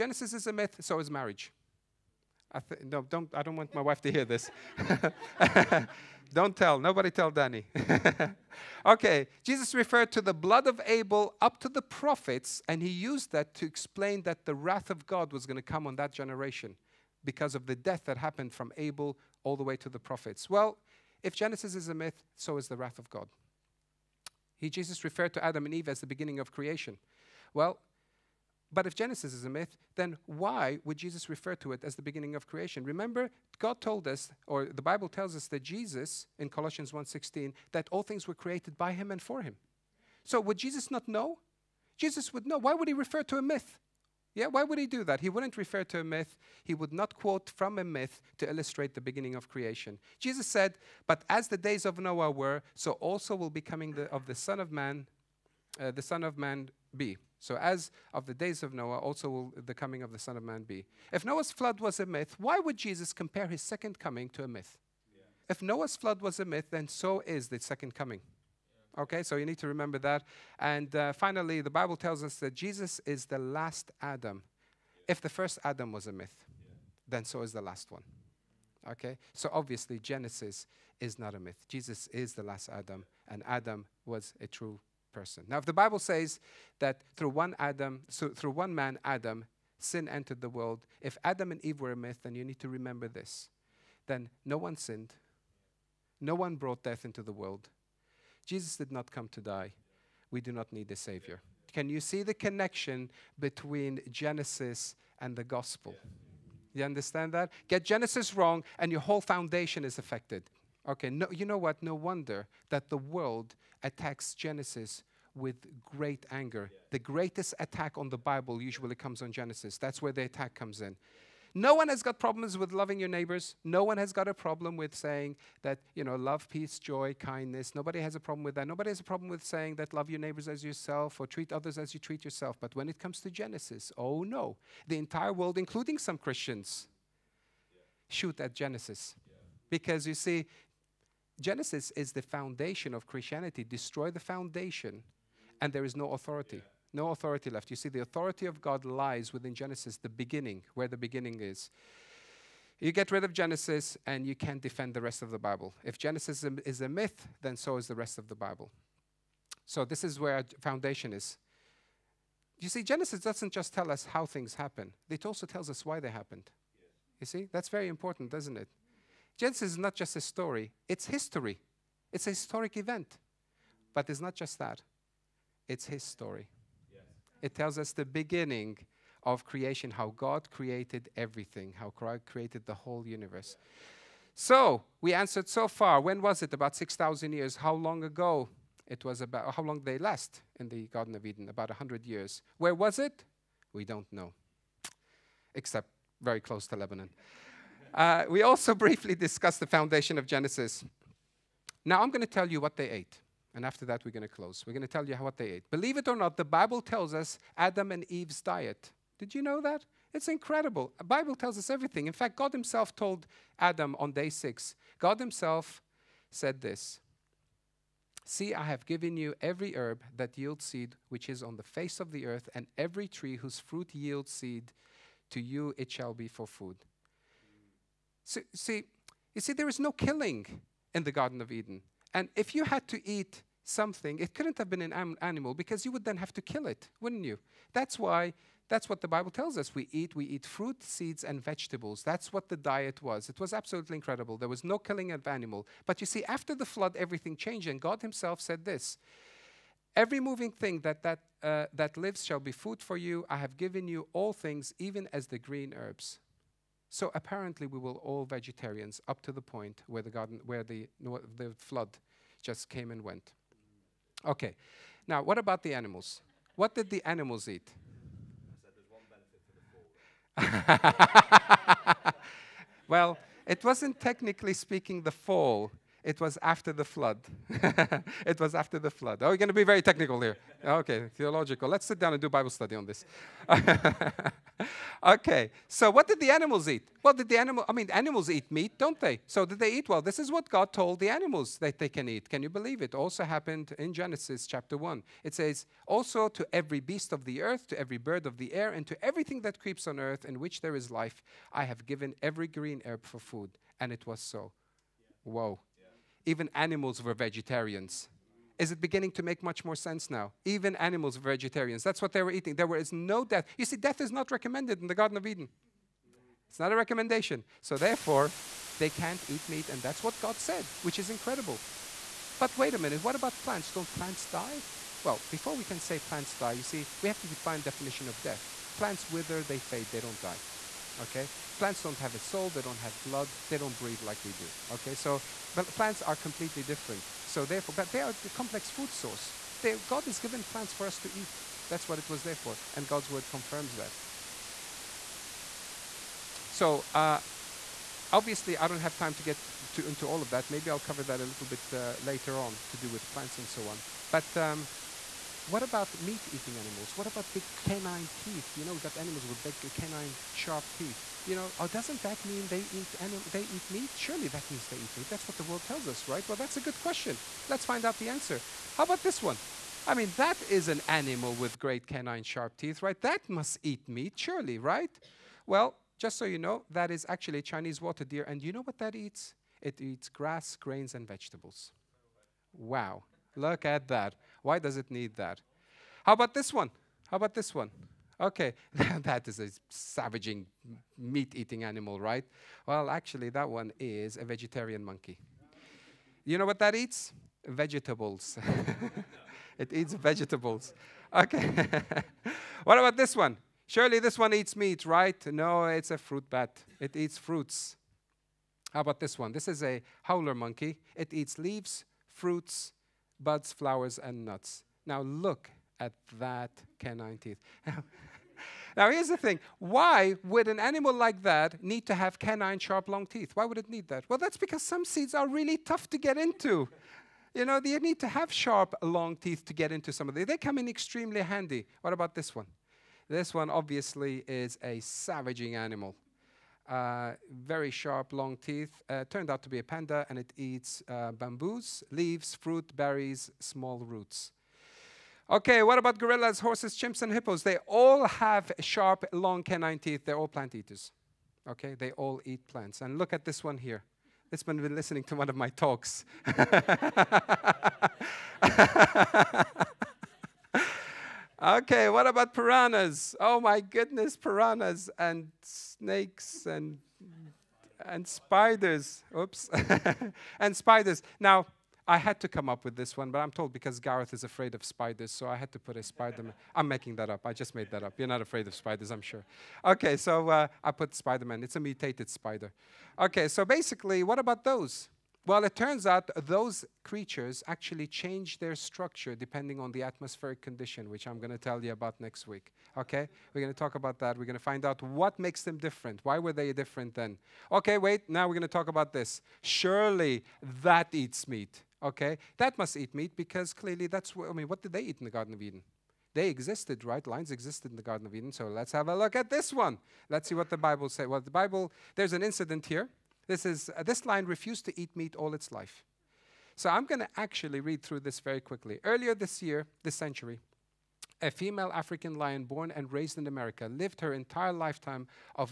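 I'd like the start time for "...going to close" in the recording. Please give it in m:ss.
3:24.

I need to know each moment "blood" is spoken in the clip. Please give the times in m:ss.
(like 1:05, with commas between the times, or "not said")
0:10, 5:33.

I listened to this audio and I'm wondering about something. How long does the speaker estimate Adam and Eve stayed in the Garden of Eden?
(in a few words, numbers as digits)
About 100 years.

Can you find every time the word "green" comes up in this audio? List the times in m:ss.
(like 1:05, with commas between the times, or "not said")
4:15, 5:02.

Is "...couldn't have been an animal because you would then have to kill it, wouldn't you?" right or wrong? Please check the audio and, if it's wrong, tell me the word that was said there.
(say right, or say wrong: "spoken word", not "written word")
right.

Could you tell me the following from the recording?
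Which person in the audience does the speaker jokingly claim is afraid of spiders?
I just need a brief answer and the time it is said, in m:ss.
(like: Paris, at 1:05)
Gareth, at 7:53.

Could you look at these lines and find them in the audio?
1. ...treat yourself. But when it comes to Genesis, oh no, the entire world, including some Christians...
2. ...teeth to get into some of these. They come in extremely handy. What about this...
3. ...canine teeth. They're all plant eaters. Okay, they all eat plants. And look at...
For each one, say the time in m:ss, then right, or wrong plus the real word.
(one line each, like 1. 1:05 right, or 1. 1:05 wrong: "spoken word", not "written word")
1. 2:11 right
2. 7:09 right
3. 7:29 right.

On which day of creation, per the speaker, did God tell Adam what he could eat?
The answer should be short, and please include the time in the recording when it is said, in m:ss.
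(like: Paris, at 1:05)
Day six, at 3:34.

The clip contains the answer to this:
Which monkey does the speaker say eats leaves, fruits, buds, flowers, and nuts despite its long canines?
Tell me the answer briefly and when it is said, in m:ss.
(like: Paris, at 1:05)
Howler monkey, at 6:50.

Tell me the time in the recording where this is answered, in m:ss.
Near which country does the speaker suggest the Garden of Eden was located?
3:16.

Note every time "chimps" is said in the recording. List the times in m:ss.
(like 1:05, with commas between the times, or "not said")
7:26.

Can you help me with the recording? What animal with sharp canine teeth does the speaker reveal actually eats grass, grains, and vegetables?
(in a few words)
Chinese water deer.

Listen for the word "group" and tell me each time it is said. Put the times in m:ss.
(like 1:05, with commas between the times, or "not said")
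not said.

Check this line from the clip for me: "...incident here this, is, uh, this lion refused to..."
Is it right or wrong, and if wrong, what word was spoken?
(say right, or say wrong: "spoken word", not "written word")
right.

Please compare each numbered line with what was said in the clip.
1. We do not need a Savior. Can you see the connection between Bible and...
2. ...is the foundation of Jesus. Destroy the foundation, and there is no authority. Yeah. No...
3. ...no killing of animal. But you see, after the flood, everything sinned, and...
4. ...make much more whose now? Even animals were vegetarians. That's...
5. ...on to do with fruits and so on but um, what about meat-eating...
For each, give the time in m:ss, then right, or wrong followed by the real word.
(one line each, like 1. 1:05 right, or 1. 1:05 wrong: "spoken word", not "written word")
1. 1:40 wrong: "Genesis", not "Bible"
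2. 2:21 wrong: "Christianity", not "Jesus"
3. 4:04 wrong: "changed", not "sinned"
4. 5:09 wrong: "sense", not "whose"
5. 5:52 wrong: "plants", not "fruits".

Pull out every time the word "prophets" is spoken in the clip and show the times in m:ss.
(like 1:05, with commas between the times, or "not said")
0:11, 0:19.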